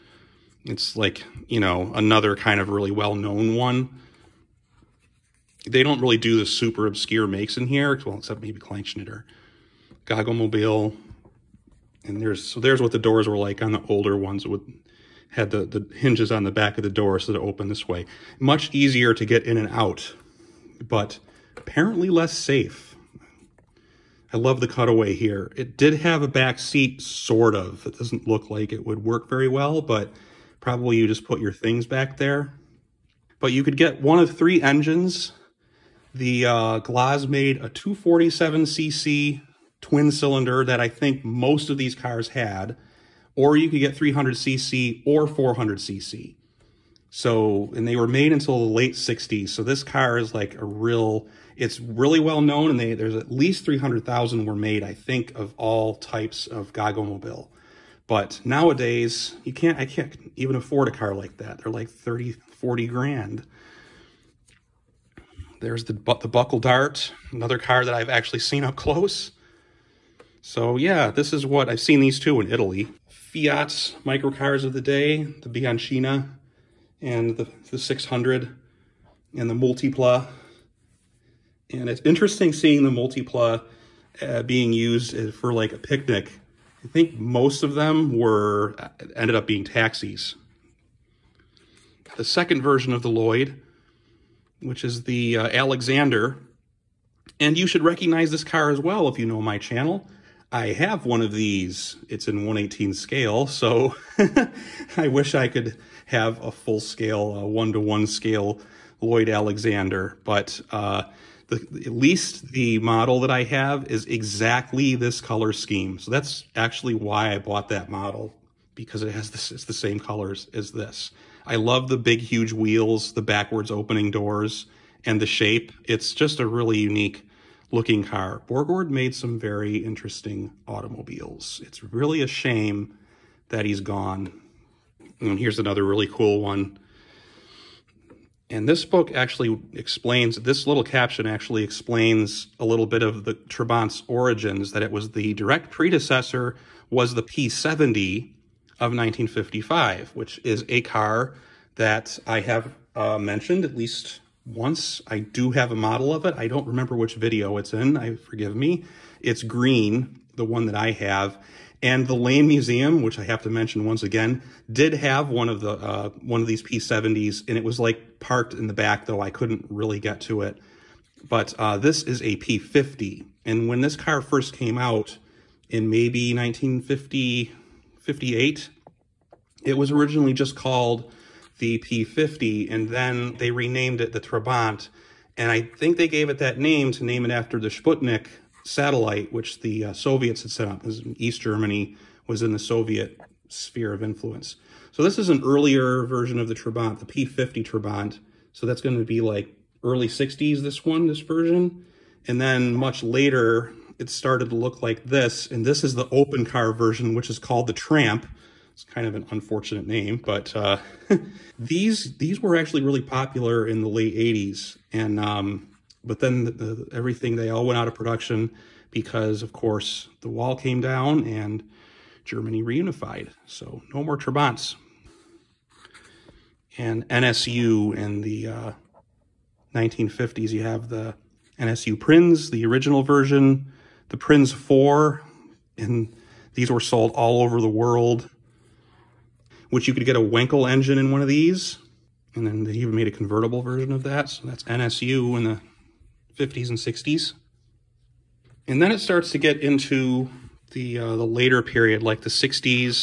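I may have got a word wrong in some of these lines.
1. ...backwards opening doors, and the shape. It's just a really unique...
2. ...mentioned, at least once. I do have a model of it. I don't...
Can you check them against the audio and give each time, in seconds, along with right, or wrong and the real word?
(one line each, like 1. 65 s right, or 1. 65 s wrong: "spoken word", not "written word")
1. 123 s right
2. 153 s right.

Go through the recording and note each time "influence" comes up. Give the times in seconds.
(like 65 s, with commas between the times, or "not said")
194 s.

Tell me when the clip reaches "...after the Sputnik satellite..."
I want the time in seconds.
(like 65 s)
187 s.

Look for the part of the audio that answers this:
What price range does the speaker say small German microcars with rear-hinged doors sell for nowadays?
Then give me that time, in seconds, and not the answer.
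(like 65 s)
61 s.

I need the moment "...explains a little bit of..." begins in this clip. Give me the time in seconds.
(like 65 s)
141 s.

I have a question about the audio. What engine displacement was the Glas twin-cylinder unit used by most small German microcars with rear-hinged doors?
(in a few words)
247cc.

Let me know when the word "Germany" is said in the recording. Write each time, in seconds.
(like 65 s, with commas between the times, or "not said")
191 s, 222 s.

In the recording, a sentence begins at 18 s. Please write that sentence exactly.
Much easier to get in and out, but apparently less safe.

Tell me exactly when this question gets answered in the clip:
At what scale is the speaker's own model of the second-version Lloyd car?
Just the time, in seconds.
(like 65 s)
102 s.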